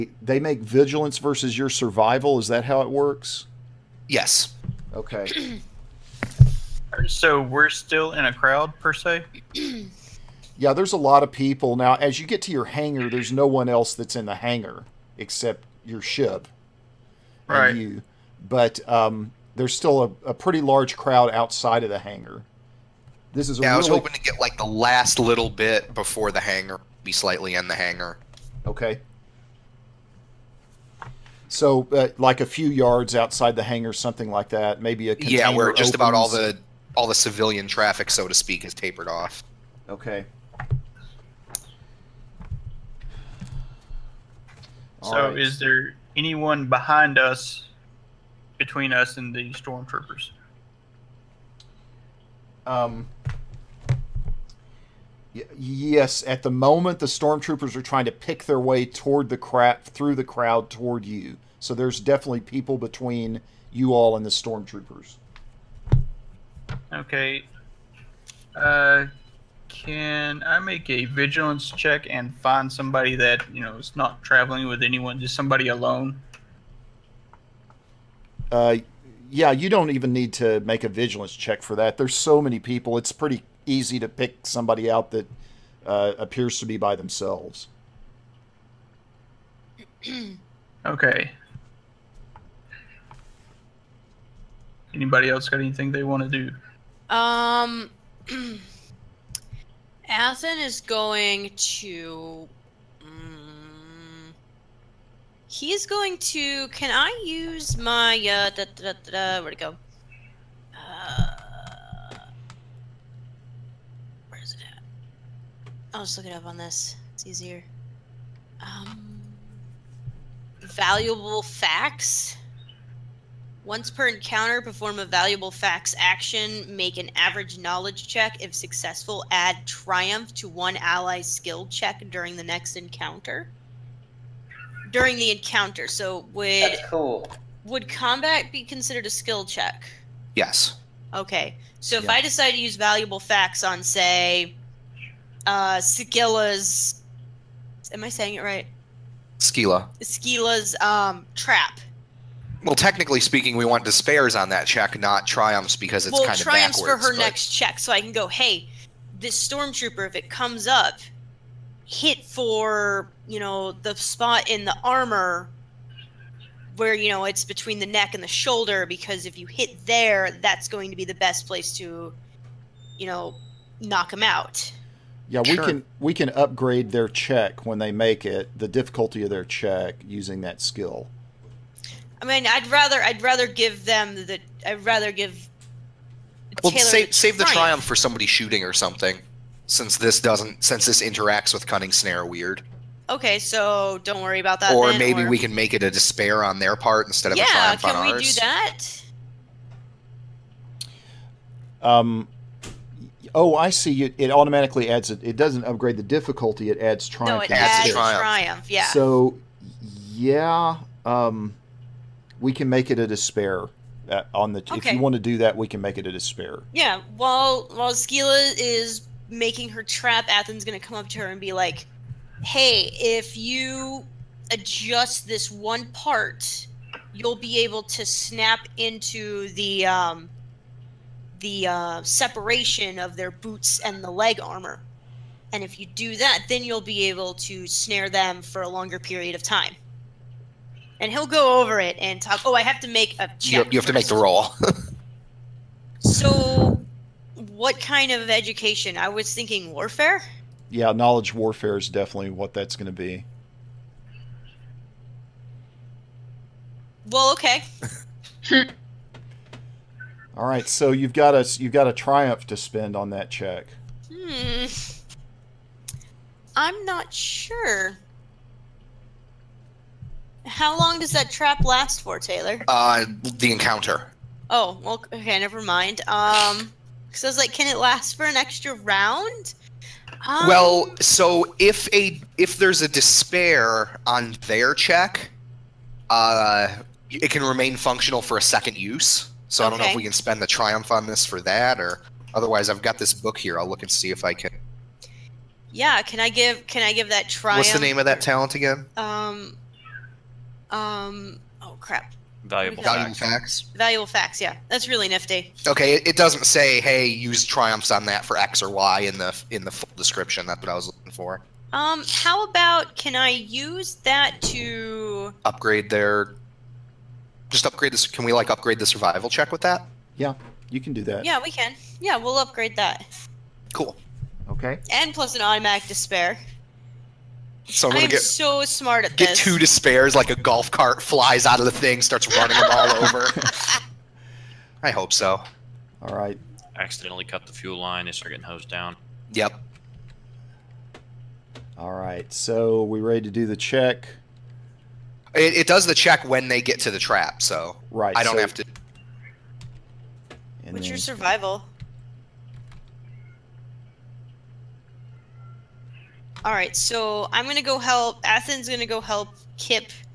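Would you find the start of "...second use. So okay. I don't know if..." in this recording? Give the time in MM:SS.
04:48.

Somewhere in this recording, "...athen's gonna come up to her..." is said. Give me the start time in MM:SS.
03:40.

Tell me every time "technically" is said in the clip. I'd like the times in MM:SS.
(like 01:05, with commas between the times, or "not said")
02:32.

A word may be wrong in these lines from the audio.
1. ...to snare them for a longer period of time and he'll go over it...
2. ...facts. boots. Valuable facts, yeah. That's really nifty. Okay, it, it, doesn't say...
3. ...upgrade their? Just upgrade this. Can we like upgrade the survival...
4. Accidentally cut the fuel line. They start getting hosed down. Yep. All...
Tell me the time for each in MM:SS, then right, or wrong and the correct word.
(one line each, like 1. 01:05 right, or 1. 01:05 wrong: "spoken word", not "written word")
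1. 03:57 right
2. 05:03 wrong: "facts", not "boots"
3. 05:15 right
4. 05:36 right.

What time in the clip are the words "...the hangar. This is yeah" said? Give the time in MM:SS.
00:21.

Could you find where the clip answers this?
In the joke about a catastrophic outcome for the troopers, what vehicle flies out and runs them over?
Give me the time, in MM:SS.
05:30.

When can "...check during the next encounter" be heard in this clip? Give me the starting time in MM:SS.
02:11.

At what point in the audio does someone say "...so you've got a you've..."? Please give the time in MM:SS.
04:20.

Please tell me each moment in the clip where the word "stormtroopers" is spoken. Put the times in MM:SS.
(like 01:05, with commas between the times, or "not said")
00:49, 00:57, 01:04, 02:39.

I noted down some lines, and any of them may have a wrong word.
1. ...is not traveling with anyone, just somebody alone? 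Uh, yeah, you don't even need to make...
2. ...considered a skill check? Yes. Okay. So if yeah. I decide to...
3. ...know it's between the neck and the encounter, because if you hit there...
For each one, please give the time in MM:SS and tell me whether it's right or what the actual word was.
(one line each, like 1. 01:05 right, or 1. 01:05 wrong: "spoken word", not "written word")
1. 01:13 right
2. 02:18 right
3. 02:47 wrong: "shoulder", not "encounter".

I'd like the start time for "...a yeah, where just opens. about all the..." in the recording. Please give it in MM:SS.
00:35.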